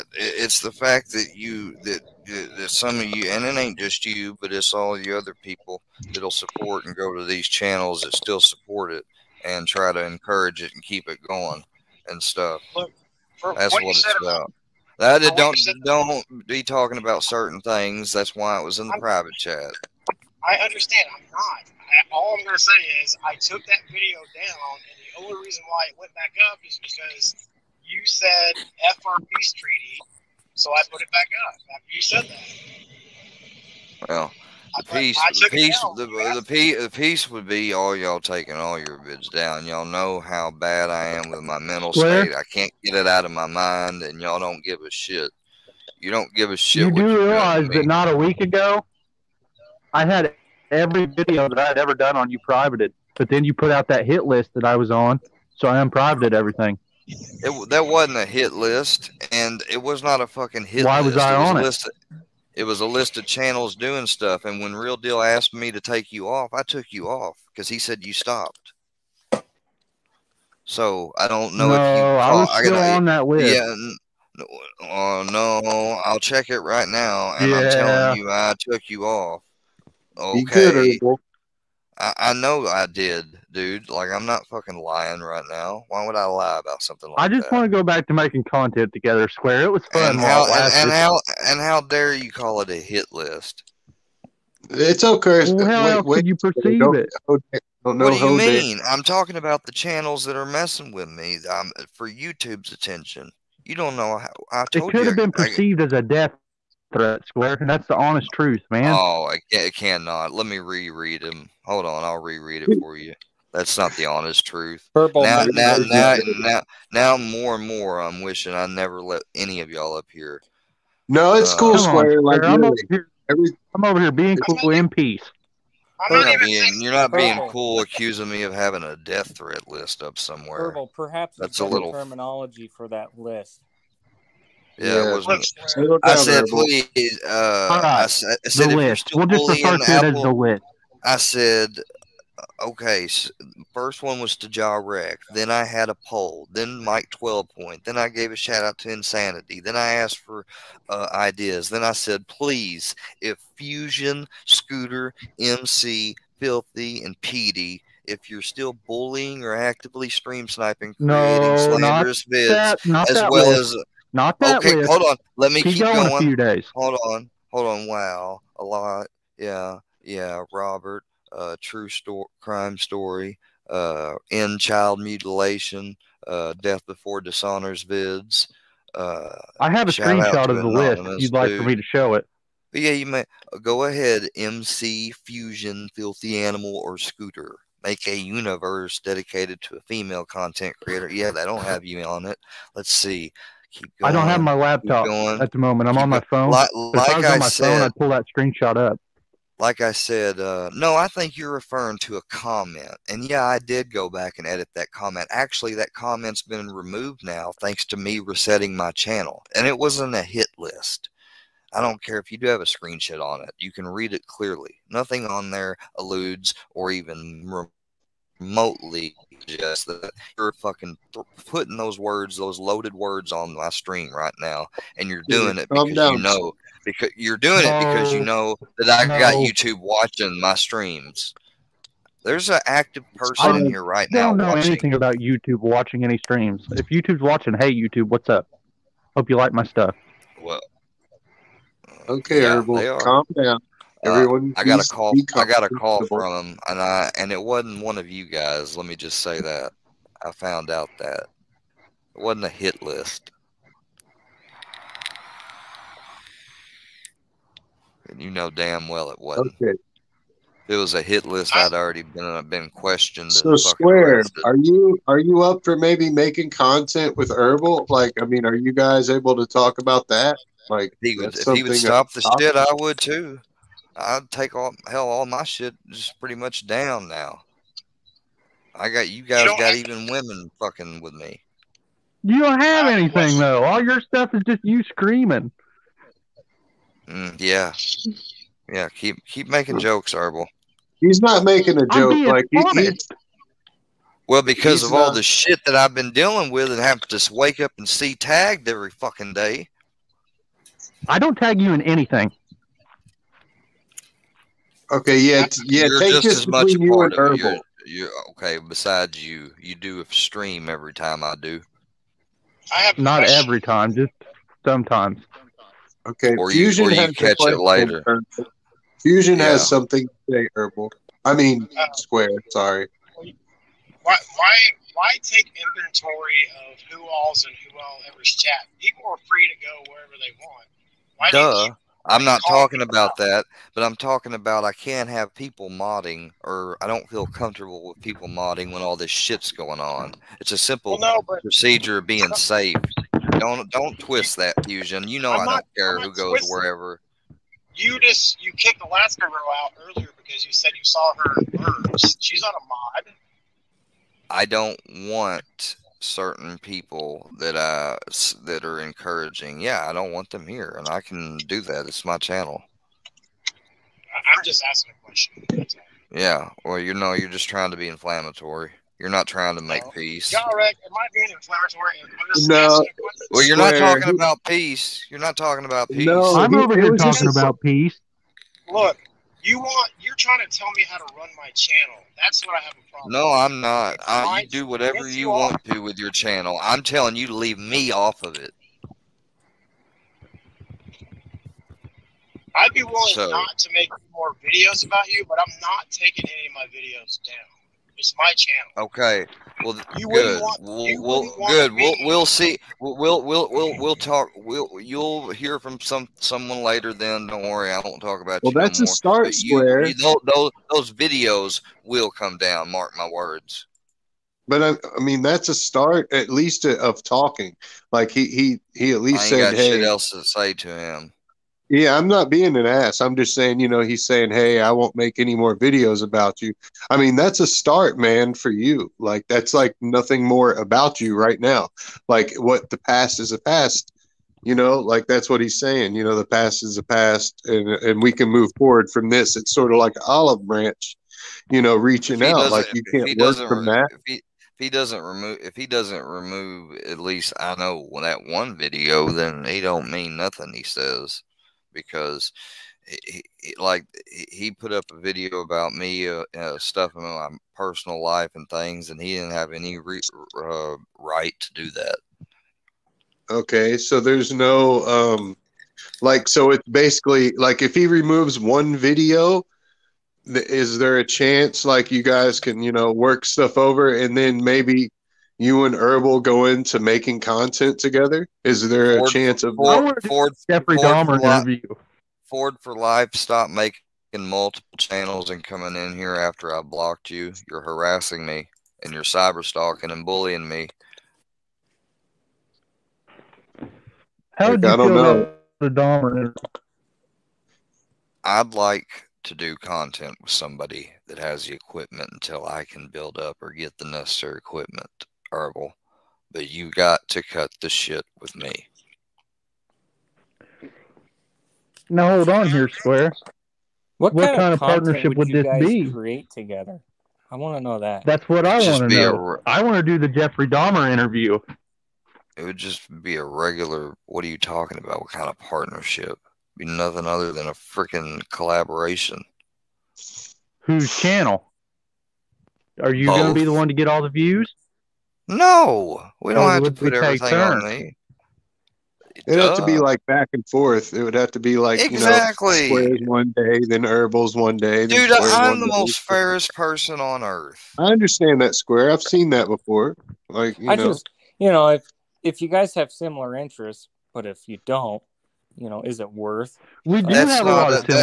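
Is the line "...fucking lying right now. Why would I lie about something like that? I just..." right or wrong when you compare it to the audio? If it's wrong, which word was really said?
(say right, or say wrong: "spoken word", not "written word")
right.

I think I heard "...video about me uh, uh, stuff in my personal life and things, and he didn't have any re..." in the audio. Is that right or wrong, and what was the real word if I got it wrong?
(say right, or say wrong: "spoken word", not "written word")
right.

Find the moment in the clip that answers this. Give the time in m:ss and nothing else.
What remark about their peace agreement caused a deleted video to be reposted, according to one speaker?
0:28.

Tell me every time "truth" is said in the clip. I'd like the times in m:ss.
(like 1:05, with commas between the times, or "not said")
1:48, 1:54.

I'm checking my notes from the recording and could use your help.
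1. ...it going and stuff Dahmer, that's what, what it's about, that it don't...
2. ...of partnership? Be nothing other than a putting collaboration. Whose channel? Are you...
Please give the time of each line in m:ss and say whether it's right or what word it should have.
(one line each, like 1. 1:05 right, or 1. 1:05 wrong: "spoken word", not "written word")
1. 0:11 wrong: "Look", not "Dahmer"
2. 8:45 wrong: "freaking", not "putting".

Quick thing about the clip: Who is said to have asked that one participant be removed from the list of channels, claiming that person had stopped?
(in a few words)
Real Deal.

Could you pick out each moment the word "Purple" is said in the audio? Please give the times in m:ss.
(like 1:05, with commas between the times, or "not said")
1:54, 2:10.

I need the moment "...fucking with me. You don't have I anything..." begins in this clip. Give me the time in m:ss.
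4:40.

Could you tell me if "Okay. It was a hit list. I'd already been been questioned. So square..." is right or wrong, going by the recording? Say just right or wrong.
right.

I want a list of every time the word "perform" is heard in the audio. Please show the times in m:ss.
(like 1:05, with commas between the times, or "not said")
not said.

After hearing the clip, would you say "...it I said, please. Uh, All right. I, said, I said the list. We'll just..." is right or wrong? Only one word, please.
right.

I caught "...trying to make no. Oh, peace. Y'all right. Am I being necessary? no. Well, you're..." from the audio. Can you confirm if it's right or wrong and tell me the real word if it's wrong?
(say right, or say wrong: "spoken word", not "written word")
wrong: "inflammatory", not "necessary".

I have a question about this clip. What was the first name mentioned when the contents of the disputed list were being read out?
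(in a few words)
Ja Wreck.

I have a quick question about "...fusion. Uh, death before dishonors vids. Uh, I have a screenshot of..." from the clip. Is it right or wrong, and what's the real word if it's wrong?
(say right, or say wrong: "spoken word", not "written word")
wrong: "mutilation", not "fusion".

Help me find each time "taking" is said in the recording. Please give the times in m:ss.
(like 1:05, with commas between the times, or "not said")
0:38, 6:35.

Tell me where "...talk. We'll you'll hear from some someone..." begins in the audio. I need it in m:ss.
6:43.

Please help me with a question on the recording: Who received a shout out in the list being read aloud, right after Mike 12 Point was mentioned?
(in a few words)
Insanity.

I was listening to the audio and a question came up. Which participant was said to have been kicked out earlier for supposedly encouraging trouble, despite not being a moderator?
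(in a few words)
Alaska Row.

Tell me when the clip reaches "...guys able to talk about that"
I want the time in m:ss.
4:28.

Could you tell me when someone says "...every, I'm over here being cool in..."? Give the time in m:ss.
2:03.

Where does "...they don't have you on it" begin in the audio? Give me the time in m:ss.
3:11.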